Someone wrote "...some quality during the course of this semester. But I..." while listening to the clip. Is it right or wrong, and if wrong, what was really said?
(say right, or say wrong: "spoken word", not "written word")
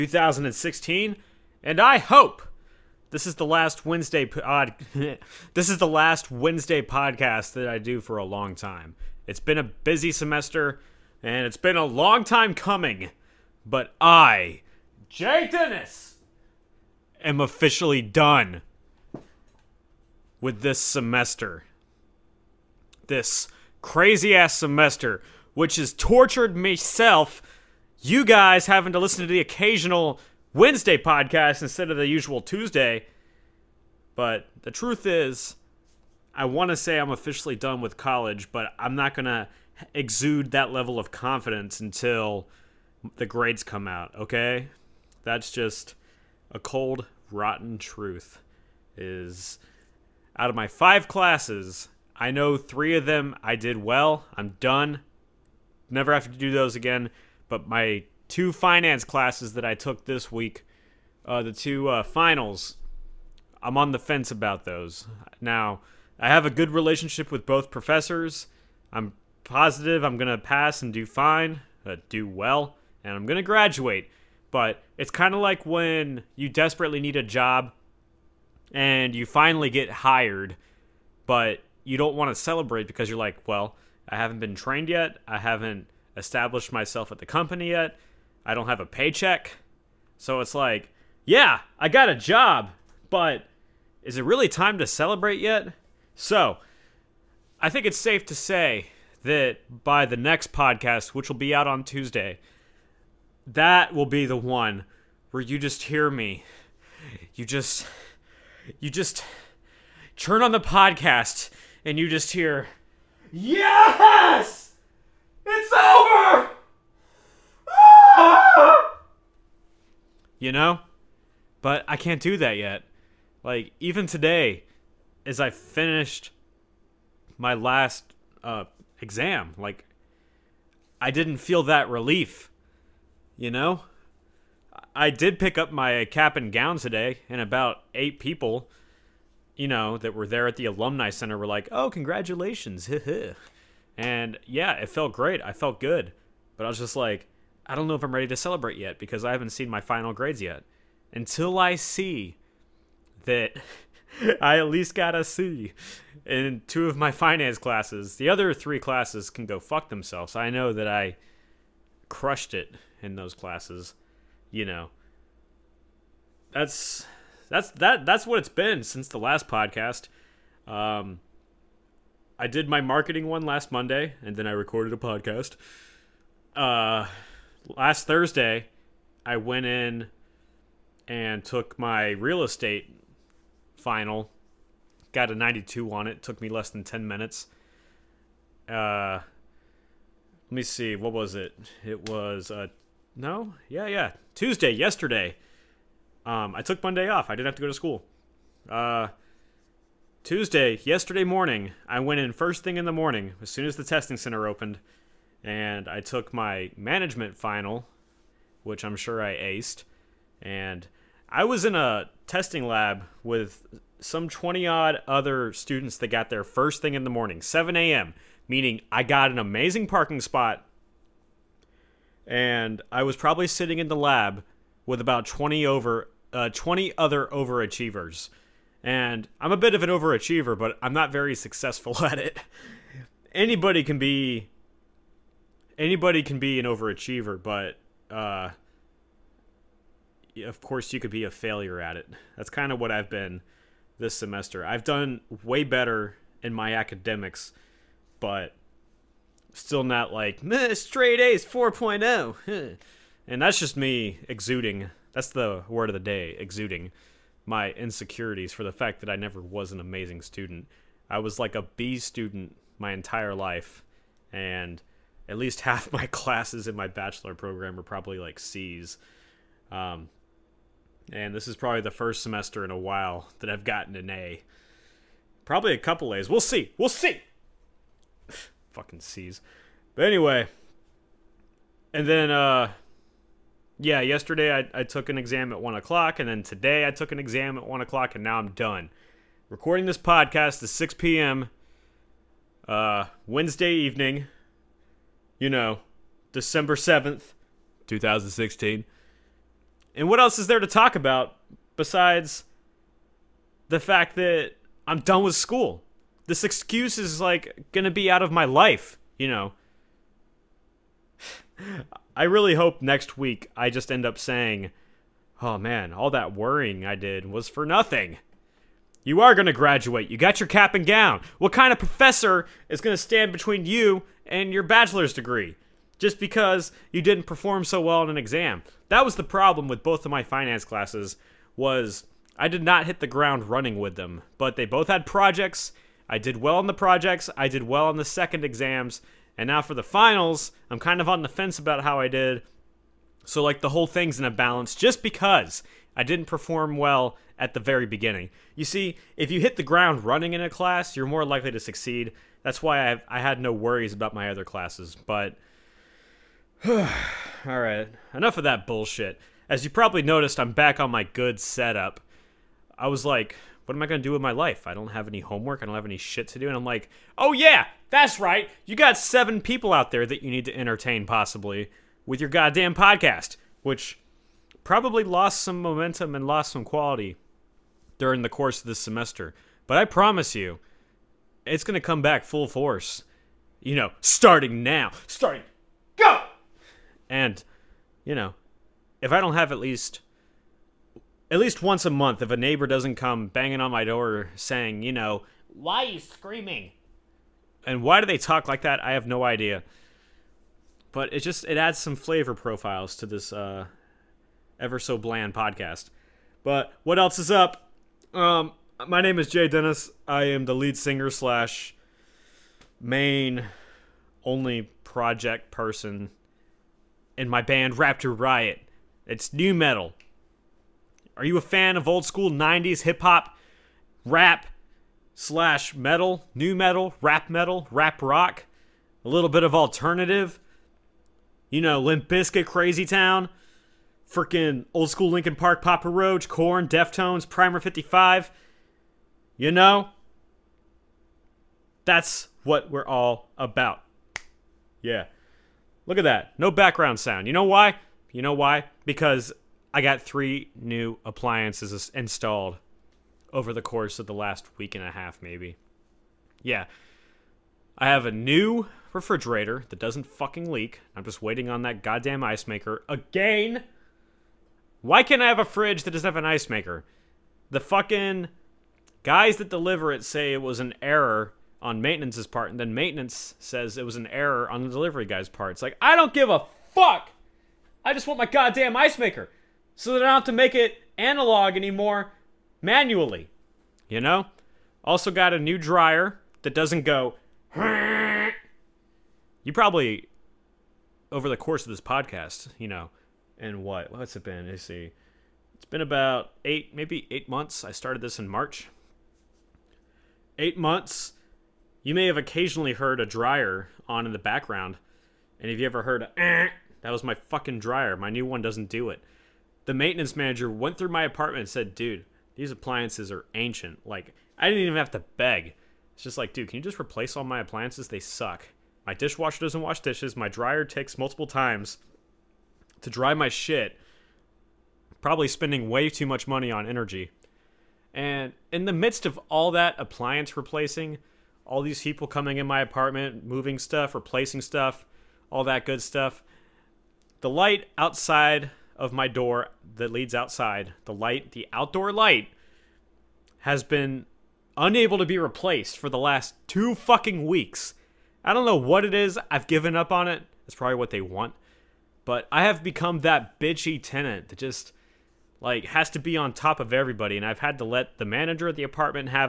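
right.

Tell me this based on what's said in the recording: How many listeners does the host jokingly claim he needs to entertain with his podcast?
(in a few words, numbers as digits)
7.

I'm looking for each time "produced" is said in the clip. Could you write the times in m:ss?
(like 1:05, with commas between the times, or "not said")
not said.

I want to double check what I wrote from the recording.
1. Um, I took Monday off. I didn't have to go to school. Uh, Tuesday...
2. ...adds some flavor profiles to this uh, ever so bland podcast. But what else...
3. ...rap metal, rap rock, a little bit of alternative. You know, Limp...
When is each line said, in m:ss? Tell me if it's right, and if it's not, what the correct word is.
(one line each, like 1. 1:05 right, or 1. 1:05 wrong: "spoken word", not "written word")
1. 3:16 right
2. 6:41 right
3. 7:07 right.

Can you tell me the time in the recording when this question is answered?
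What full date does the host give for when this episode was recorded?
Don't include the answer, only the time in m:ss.
4:56.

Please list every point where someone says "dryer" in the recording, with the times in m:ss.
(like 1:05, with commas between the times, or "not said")
8:05, 8:23, 8:27, 8:40.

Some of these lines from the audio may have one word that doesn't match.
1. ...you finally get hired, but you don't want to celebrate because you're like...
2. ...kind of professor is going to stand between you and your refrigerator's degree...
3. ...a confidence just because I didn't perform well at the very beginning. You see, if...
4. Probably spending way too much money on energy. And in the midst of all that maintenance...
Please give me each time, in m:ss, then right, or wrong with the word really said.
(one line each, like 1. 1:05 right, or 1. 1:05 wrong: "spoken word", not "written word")
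1. 1:19 right
2. 5:21 wrong: "bachelor", not "refrigerator"
3. 5:44 wrong: "balance", not "confidence"
4. 8:45 wrong: "appliance", not "maintenance".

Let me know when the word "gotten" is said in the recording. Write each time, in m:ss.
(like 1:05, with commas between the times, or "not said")
4:33.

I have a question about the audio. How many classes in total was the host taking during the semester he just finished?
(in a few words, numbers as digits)
5.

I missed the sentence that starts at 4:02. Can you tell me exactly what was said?
That's kind of what I've been this semester.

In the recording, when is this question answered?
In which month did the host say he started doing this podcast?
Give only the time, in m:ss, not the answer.
8:18.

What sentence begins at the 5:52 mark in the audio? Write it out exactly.
That's why I, I had no worries about my other classes.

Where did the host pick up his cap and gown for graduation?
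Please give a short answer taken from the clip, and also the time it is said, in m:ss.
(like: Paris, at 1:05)
Alumni Center, at 2:20.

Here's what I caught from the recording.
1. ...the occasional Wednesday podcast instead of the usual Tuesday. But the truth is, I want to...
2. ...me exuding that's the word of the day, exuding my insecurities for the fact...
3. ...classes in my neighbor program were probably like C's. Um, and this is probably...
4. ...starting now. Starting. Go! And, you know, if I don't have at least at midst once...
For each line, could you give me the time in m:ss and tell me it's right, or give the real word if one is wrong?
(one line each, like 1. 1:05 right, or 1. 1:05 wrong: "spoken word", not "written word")
1. 0:29 right
2. 4:13 right
3. 4:26 wrong: "bachelor", not "neighbor"
4. 6:23 wrong: "least", not "midst".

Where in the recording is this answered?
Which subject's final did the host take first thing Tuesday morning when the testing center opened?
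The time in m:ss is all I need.
3:26.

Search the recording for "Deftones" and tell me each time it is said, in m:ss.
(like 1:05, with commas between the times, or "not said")
7:16.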